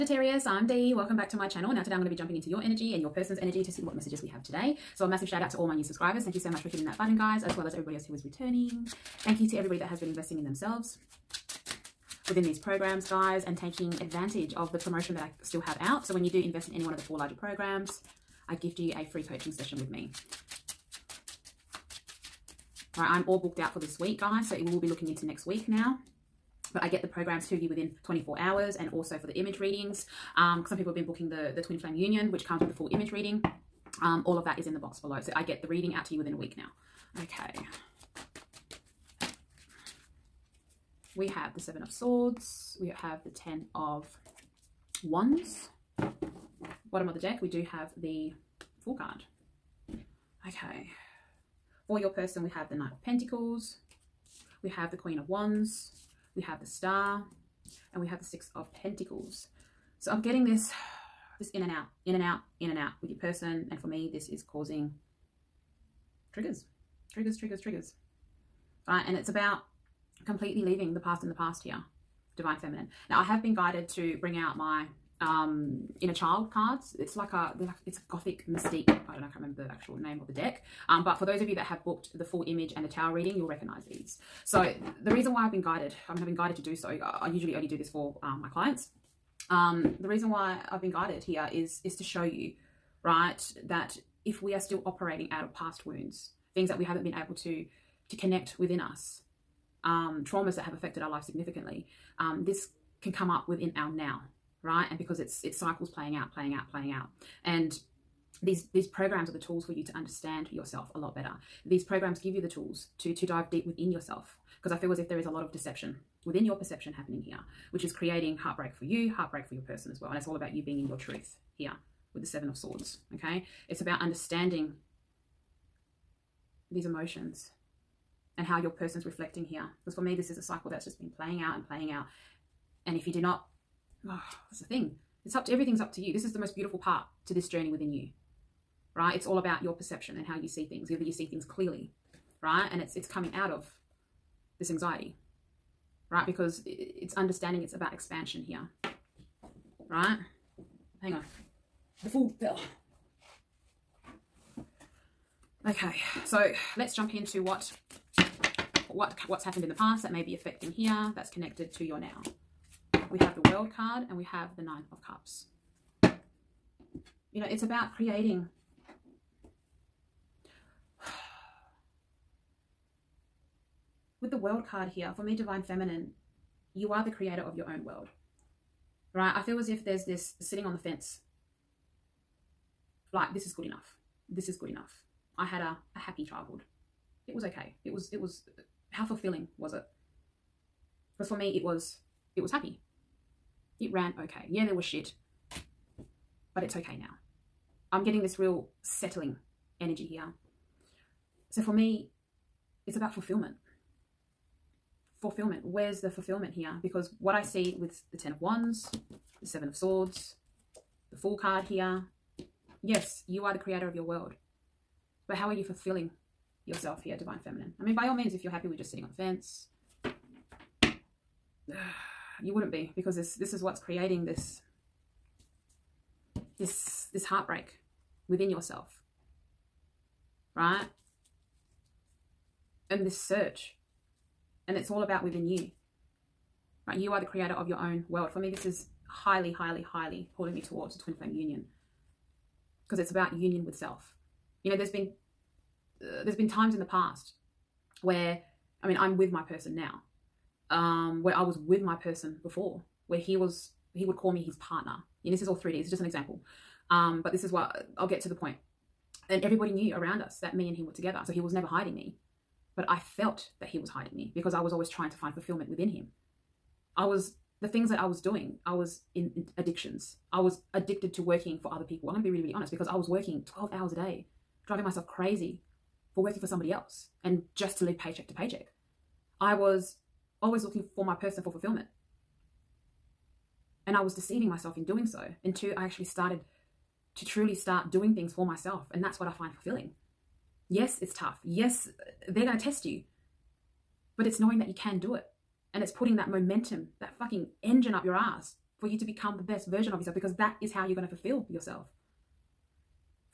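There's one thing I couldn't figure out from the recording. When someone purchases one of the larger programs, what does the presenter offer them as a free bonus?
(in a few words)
Coaching session.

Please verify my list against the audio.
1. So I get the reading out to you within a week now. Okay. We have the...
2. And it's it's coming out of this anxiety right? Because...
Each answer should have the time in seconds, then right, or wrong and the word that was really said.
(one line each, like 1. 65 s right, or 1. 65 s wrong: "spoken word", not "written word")
1. 35 s right
2. 142 s right.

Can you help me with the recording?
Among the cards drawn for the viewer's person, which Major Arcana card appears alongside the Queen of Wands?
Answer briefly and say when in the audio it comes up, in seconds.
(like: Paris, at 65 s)
The Star, at 56 s.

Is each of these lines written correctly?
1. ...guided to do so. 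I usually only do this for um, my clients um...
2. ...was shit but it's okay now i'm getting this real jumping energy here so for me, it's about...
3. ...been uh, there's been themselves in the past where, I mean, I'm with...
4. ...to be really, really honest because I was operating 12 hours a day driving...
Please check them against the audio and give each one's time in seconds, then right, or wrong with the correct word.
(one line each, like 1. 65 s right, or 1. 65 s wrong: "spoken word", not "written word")
1. 86 s right
2. 194 s wrong: "settling", not "jumping"
3. 244 s wrong: "times", not "themselves"
4. 272 s wrong: "working", not "operating".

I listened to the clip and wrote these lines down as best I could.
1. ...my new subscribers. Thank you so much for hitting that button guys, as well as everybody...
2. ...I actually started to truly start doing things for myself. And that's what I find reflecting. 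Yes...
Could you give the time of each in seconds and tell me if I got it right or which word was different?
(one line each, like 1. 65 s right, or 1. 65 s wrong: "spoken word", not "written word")
1. 5 s right
2. 285 s wrong: "fulfilling", not "reflecting".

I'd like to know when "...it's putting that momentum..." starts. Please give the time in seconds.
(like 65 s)
295 s.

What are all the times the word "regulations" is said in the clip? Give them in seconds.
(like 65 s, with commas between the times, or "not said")
not said.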